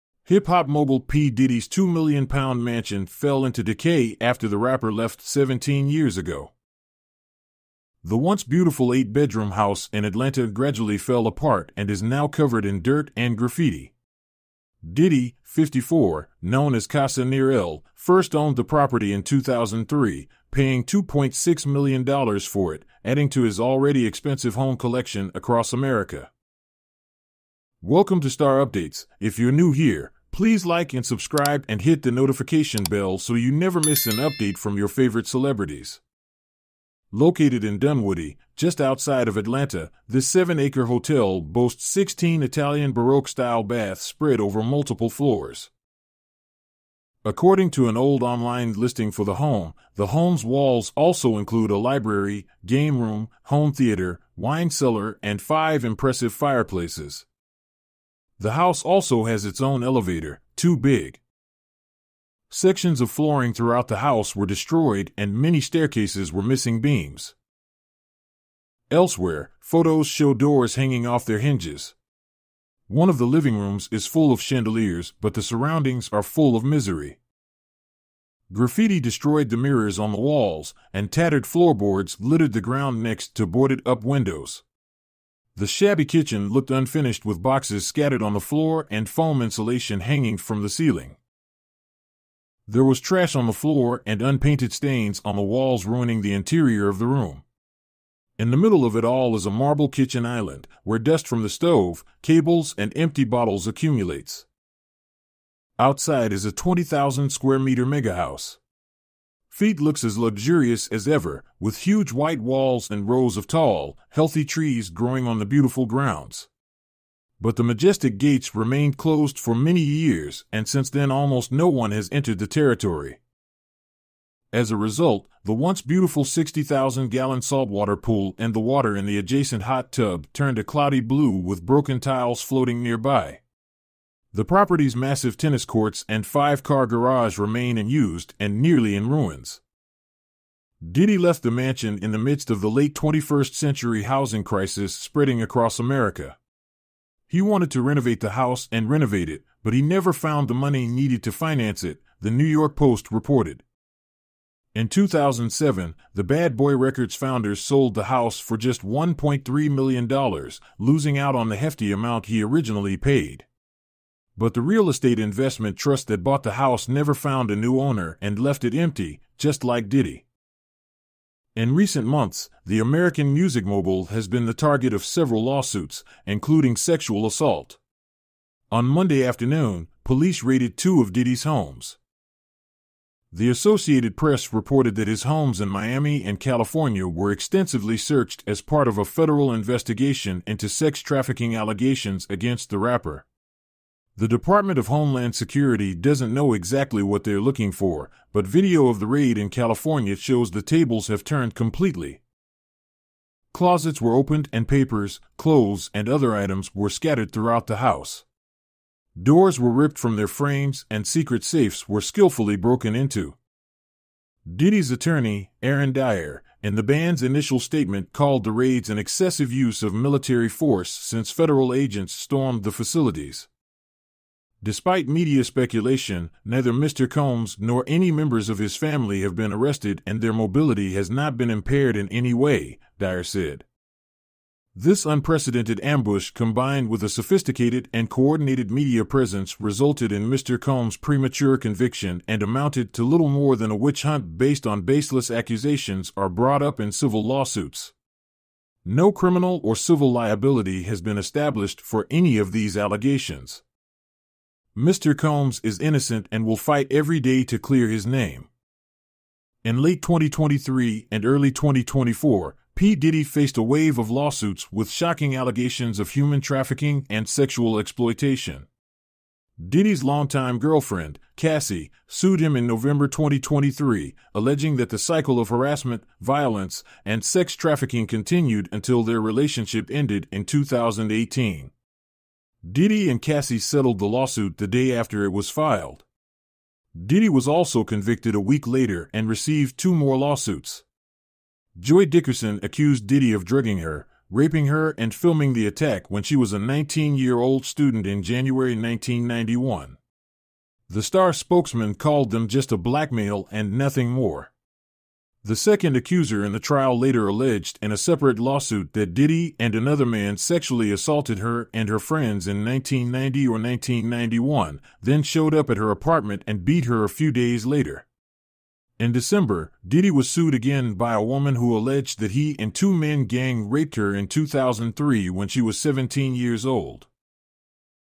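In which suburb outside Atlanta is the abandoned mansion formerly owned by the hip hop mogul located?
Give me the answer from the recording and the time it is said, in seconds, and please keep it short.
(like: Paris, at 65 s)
Dunwoody, at 37 s.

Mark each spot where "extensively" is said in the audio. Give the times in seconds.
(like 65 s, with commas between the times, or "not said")
187 s.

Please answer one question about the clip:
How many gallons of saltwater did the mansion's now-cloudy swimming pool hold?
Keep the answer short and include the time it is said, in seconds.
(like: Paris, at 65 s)
60,000, at 126 s.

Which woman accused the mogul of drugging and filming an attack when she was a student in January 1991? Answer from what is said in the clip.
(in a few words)
Joy Dickerson.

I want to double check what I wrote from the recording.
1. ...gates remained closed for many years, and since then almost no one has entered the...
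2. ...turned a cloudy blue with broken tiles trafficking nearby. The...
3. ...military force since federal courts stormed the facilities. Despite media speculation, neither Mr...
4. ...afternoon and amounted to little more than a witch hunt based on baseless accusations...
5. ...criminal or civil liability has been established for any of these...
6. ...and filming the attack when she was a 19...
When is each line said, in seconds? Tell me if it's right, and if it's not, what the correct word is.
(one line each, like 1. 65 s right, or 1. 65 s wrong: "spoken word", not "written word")
1. 118 s right
2. 130 s wrong: "floating", not "trafficking"
3. 219 s wrong: "agents", not "courts"
4. 241 s wrong: "conviction", not "afternoon"
5. 249 s right
6. 294 s right.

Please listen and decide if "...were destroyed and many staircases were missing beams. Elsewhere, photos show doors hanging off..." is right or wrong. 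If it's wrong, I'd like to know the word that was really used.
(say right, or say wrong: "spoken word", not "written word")
right.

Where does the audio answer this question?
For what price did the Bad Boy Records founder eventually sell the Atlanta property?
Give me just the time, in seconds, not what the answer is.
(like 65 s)
158 s.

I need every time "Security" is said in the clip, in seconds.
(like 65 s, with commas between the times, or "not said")
195 s.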